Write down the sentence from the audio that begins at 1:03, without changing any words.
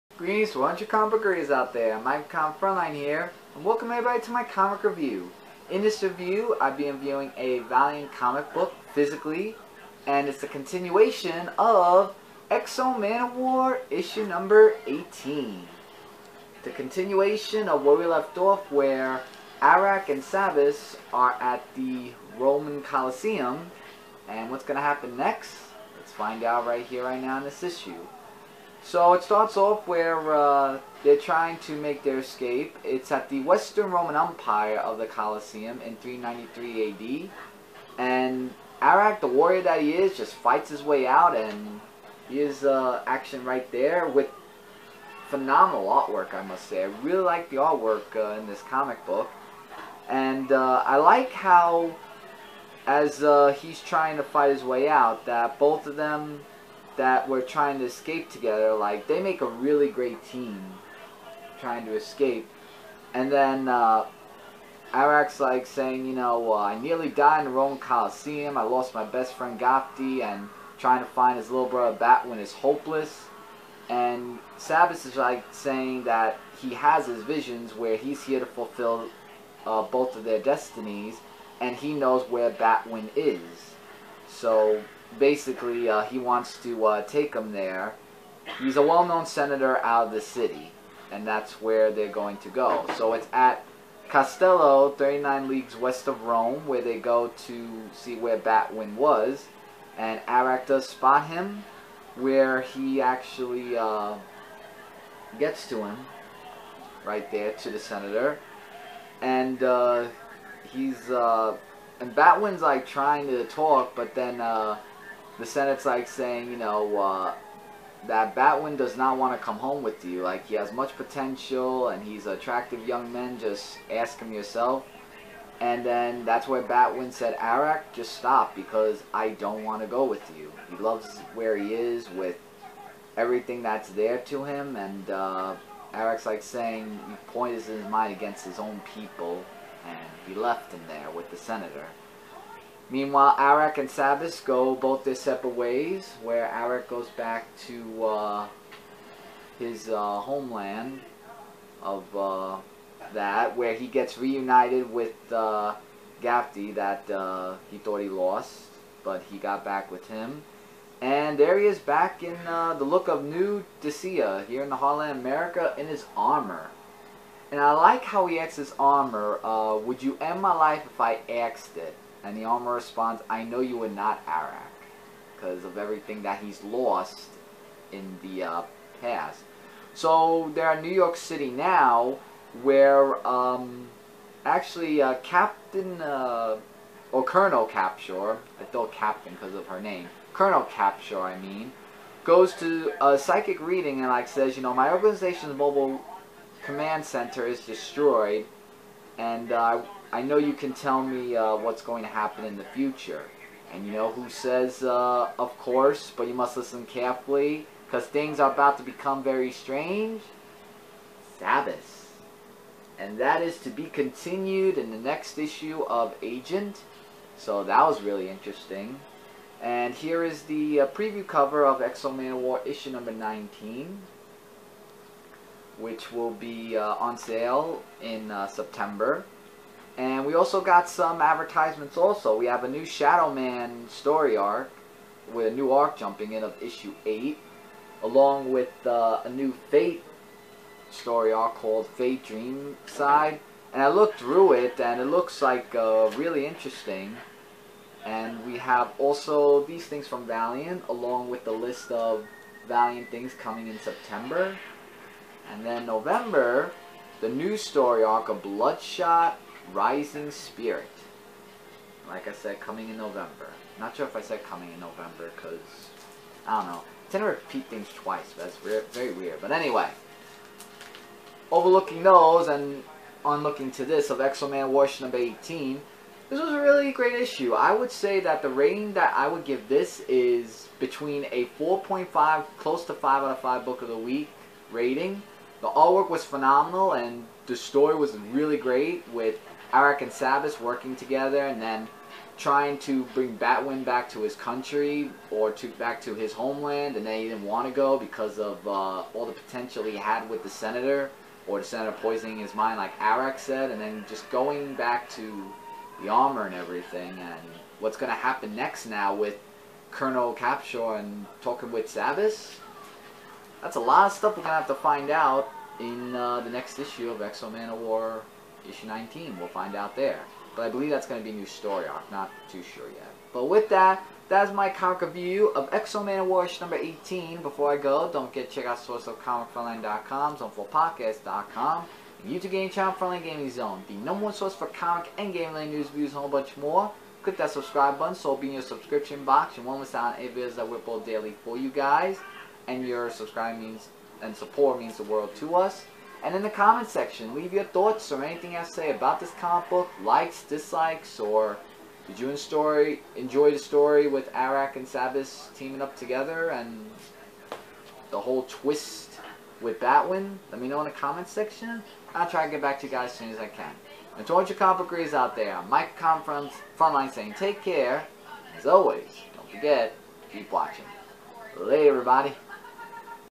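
And then uh, Aric's like saying, you know, uh, I nearly died in the Roman Coliseum.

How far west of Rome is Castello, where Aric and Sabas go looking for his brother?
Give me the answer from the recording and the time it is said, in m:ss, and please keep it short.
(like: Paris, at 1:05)
39 leagues, at 1:34.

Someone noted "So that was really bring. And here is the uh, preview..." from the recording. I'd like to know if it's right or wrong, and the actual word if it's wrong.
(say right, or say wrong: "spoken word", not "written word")
wrong: "interesting", not "bring".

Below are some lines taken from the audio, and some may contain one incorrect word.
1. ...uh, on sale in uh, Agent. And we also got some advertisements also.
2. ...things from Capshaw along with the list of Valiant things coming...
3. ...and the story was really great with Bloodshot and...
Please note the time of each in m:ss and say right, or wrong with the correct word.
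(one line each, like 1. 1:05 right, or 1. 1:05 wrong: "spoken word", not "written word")
1. 3:46 wrong: "September", not "Agent"
2. 4:09 wrong: "Valiant", not "Capshaw"
3. 4:46 wrong: "Aric", not "Bloodshot".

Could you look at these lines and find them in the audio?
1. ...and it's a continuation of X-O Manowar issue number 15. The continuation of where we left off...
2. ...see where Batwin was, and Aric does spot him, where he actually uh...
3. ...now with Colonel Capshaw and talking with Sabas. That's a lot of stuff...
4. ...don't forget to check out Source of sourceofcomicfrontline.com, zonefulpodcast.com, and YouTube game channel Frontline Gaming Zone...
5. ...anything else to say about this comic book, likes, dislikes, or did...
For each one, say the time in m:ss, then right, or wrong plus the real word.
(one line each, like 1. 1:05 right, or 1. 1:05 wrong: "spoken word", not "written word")
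1. 0:10 wrong: "18", not "15"
2. 1:37 right
3. 5:08 right
4. 5:28 right
5. 5:48 right.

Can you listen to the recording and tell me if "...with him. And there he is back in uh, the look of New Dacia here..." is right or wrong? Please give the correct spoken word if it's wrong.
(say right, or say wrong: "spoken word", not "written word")
right.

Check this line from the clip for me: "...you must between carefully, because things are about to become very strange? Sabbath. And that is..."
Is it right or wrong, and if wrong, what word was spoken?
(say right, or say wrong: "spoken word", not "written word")
wrong: "listen", not "between".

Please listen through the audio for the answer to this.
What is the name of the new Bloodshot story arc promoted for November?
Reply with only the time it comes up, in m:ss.
4:18.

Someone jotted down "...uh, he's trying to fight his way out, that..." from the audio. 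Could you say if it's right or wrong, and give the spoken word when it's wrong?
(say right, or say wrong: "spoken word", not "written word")
right.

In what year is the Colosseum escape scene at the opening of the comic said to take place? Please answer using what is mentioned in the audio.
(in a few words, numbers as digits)
393 AD.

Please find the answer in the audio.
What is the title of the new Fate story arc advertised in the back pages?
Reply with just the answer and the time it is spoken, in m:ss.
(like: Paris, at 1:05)
Fate Dream Side, at 4:01.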